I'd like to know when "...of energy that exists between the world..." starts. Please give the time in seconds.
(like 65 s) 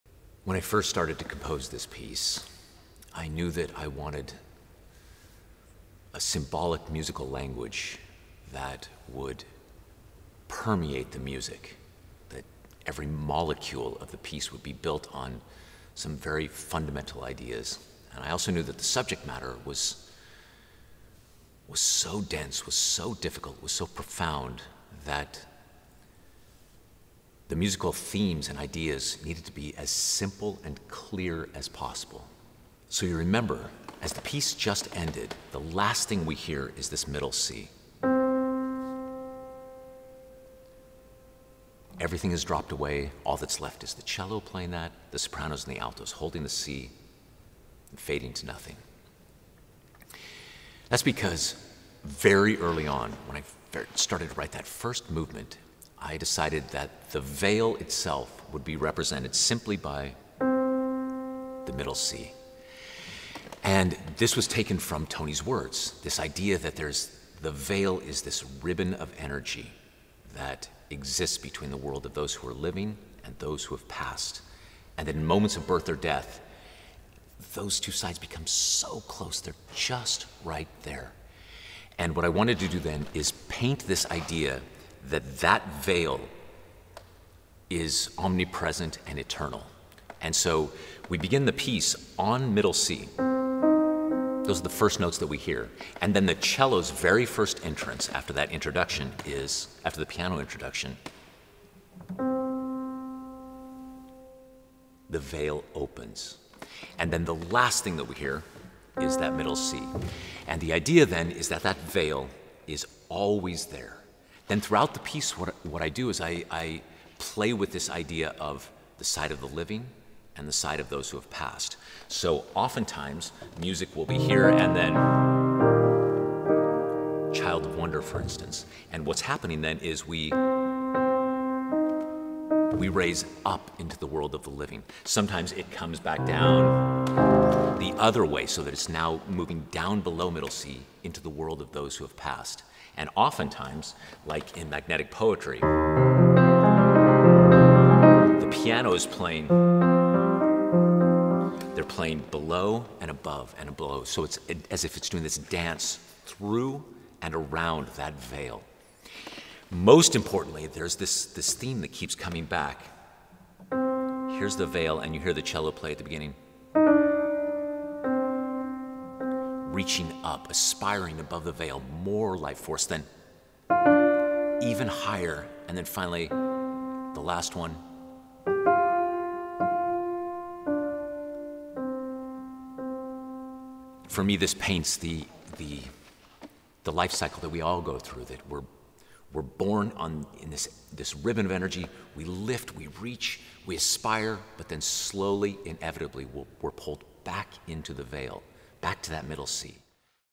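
68 s.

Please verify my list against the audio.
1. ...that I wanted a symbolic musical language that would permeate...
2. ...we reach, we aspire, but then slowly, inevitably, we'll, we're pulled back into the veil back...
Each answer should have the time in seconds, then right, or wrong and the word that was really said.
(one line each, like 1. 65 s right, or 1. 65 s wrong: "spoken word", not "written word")
1. 3 s right
2. 192 s right.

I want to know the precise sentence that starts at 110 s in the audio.
And the idea then is that that veil is always there.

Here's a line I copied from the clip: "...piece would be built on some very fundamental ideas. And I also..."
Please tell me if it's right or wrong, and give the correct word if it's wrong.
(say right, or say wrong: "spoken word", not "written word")
right.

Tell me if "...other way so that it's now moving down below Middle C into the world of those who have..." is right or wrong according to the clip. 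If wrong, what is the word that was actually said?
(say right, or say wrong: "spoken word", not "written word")
right.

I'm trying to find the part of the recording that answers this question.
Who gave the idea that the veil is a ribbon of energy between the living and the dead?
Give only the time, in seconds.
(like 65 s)
65 s.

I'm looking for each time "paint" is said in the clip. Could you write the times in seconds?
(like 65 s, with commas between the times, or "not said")
83 s, 184 s.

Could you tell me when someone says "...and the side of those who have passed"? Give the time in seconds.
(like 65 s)
120 s.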